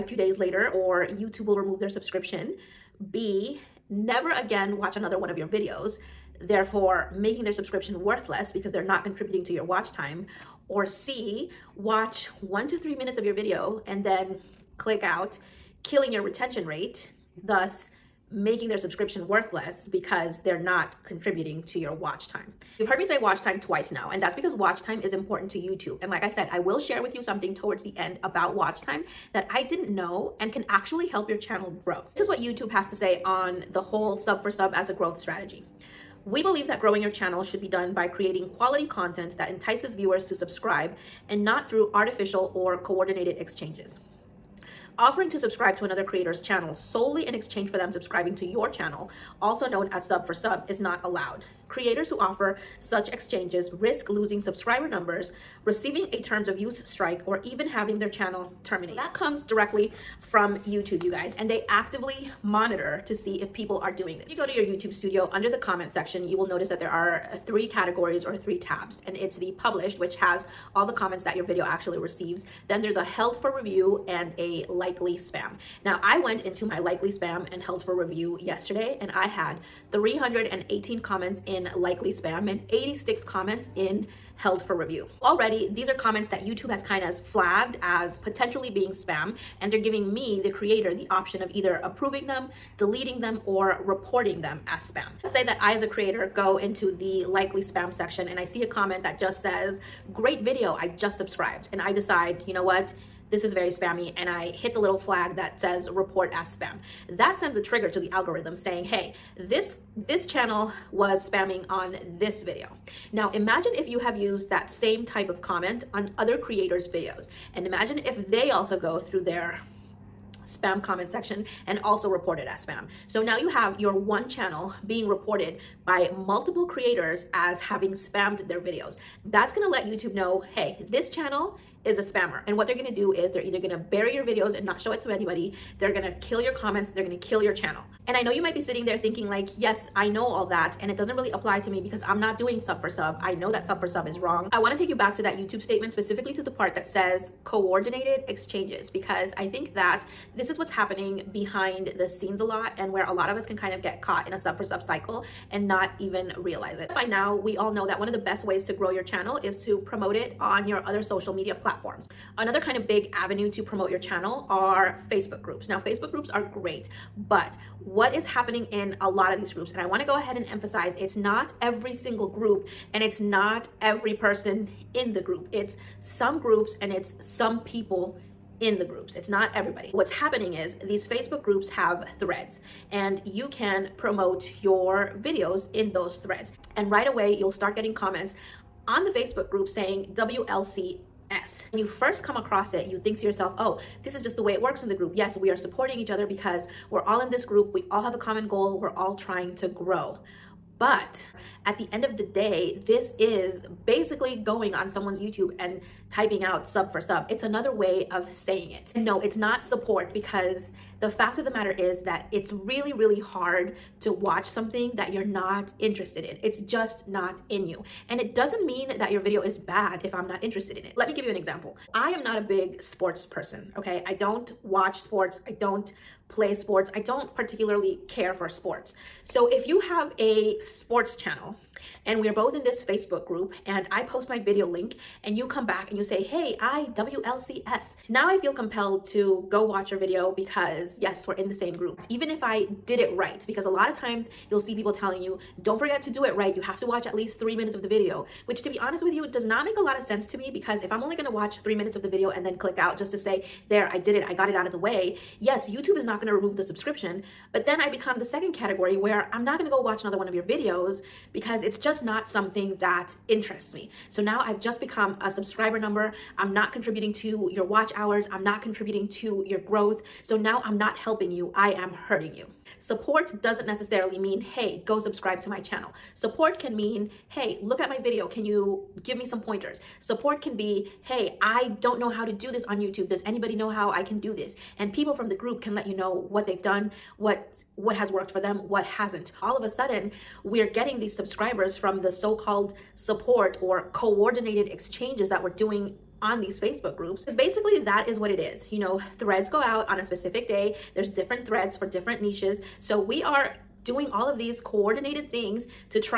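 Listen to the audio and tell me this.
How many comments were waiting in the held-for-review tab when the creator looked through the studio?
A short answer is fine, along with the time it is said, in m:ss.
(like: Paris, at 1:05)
86, at 1:22.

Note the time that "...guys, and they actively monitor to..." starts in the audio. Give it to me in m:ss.
1:01.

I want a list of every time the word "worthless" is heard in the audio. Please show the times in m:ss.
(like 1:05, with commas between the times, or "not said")
0:08, 0:19.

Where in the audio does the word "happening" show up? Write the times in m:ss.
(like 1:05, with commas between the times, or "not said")
2:30, 2:48, 3:00.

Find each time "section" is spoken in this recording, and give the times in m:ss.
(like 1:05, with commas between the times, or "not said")
1:05, 1:37, 2:01.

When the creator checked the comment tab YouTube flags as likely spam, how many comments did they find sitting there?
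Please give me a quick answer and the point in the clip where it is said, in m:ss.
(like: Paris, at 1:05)
318, at 1:19.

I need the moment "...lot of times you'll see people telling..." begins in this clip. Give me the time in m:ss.
4:03.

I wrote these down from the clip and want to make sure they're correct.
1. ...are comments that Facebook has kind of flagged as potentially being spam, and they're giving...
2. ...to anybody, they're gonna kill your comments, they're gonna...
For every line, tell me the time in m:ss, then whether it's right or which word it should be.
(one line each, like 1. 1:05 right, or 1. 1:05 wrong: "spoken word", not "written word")
1. 1:25 wrong: "YouTube", not "Facebook"
2. 2:15 right.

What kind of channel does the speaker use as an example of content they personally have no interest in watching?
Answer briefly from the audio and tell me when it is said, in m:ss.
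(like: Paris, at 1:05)
sports channel, at 3:50.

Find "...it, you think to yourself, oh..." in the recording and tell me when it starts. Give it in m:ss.
3:12.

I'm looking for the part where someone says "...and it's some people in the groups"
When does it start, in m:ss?
2:56.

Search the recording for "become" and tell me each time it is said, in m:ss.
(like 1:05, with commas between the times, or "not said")
4:17, 4:24.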